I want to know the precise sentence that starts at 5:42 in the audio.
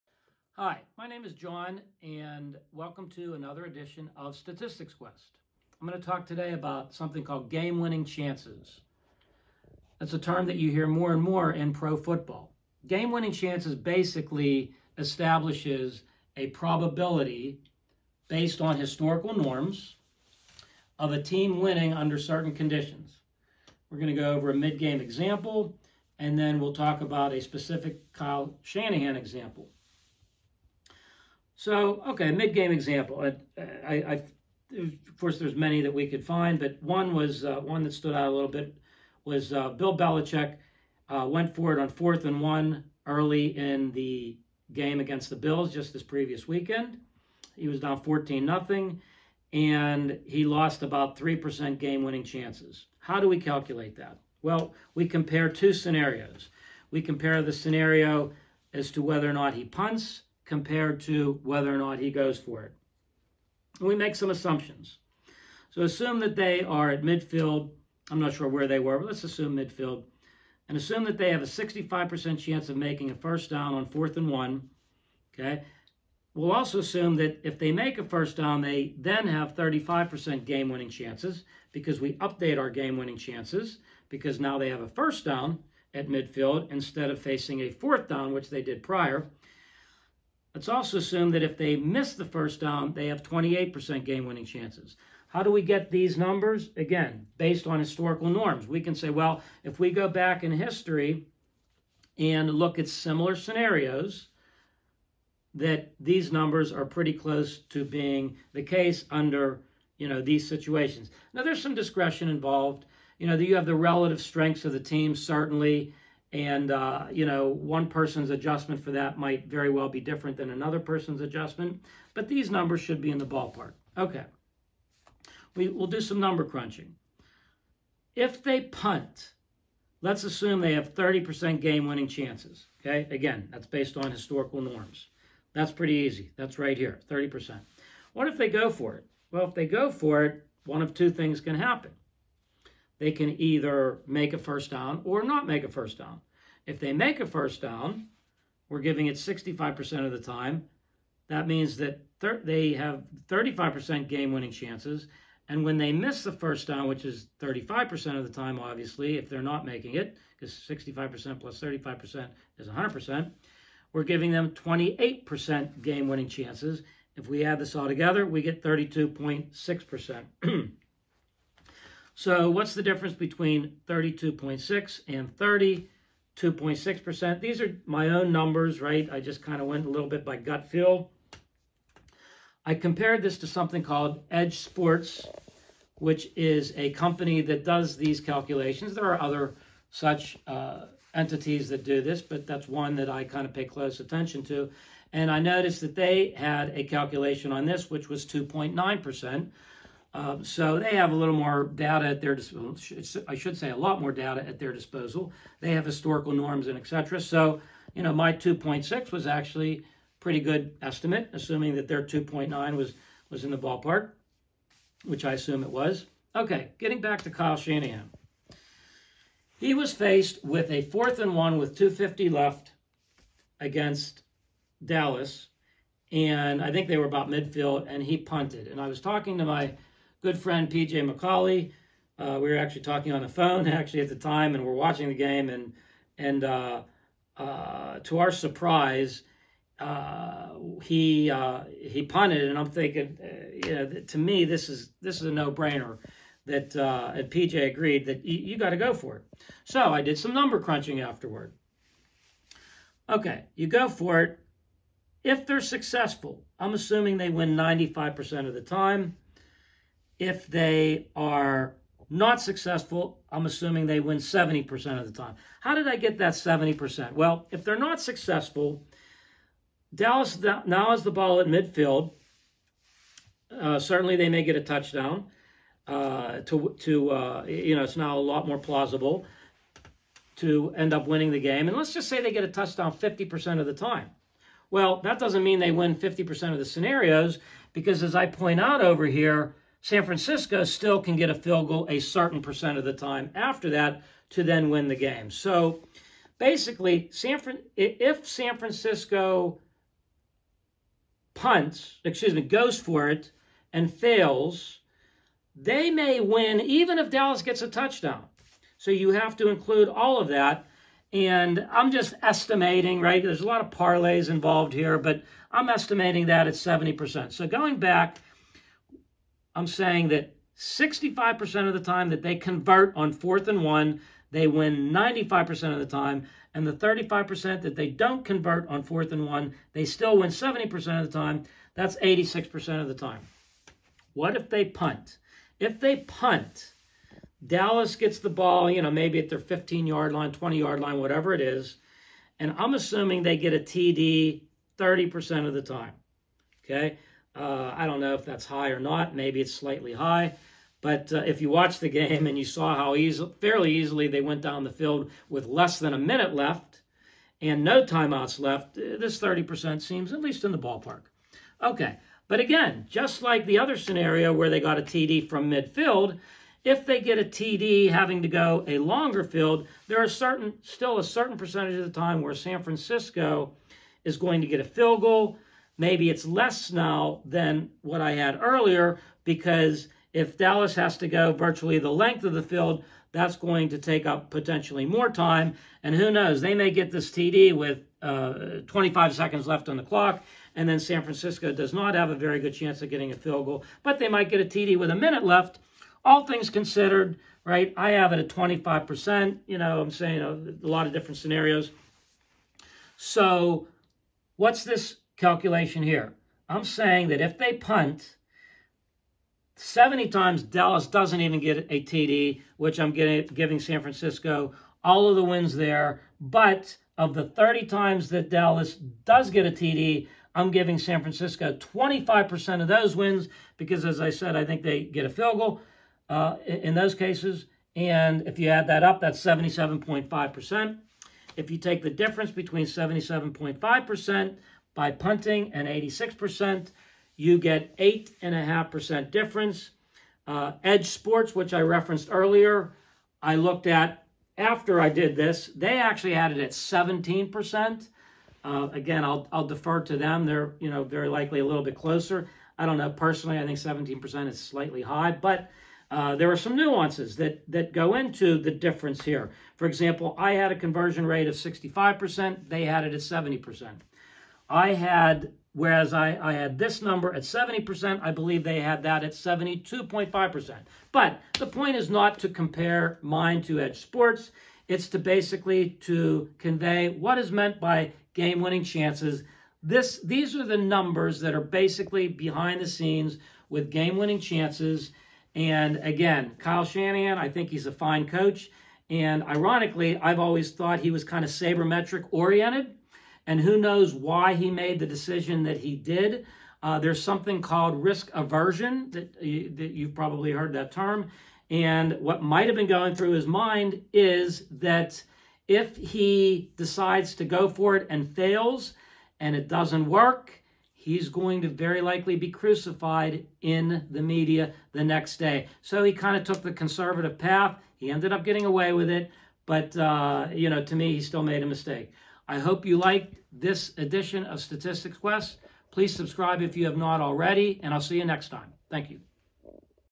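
And I'm assuming they get a TD 30% of the time.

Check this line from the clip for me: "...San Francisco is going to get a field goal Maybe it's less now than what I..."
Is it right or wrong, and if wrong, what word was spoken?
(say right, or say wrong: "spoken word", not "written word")
right.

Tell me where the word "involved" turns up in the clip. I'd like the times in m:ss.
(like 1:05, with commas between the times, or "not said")
1:52, 5:14.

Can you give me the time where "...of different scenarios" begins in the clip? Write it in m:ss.
6:40.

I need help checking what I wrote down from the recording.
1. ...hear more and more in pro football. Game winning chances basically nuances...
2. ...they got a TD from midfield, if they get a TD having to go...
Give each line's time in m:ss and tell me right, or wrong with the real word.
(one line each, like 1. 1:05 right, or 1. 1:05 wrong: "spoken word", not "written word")
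1. 0:10 wrong: "establishes", not "nuances"
2. 6:04 right.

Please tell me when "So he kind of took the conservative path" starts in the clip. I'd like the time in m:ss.
8:35.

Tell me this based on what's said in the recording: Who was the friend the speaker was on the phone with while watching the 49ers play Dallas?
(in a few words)
PJ McCauley.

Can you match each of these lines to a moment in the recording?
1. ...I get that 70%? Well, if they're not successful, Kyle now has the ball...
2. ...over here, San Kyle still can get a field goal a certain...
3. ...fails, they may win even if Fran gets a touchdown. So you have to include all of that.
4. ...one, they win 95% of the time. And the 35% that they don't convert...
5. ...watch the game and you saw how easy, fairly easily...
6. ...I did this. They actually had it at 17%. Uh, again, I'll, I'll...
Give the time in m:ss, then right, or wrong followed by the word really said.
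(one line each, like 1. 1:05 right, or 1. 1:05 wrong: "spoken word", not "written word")
1. 4:25 wrong: "Dallas", not "Kyle"
2. 4:48 wrong: "Francisco", not "Kyle"
3. 5:03 wrong: "Dallas", not "Fran"
4. 5:23 right
5. 5:51 right
6. 7:24 right.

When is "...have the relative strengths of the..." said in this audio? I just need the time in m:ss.
1:53.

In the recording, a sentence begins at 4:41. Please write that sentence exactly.
And let's just say they get a touchdown 50% of the time.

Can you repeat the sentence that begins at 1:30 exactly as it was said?
Let's also assume that if they miss the first down, they have 28% game winning chances.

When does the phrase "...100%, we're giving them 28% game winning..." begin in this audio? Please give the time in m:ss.
2:42.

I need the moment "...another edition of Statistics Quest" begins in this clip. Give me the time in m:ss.
0:03.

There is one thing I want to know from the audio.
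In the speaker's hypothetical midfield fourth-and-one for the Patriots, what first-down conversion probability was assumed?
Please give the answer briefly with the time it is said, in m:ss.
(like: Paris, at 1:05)
65%, at 1:11.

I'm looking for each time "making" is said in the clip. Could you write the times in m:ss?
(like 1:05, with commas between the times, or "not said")
1:12, 2:39.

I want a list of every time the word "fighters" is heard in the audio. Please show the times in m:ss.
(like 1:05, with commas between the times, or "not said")
not said.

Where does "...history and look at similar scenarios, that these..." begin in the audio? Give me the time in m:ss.
1:40.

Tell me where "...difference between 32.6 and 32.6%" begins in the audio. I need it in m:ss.
2:52.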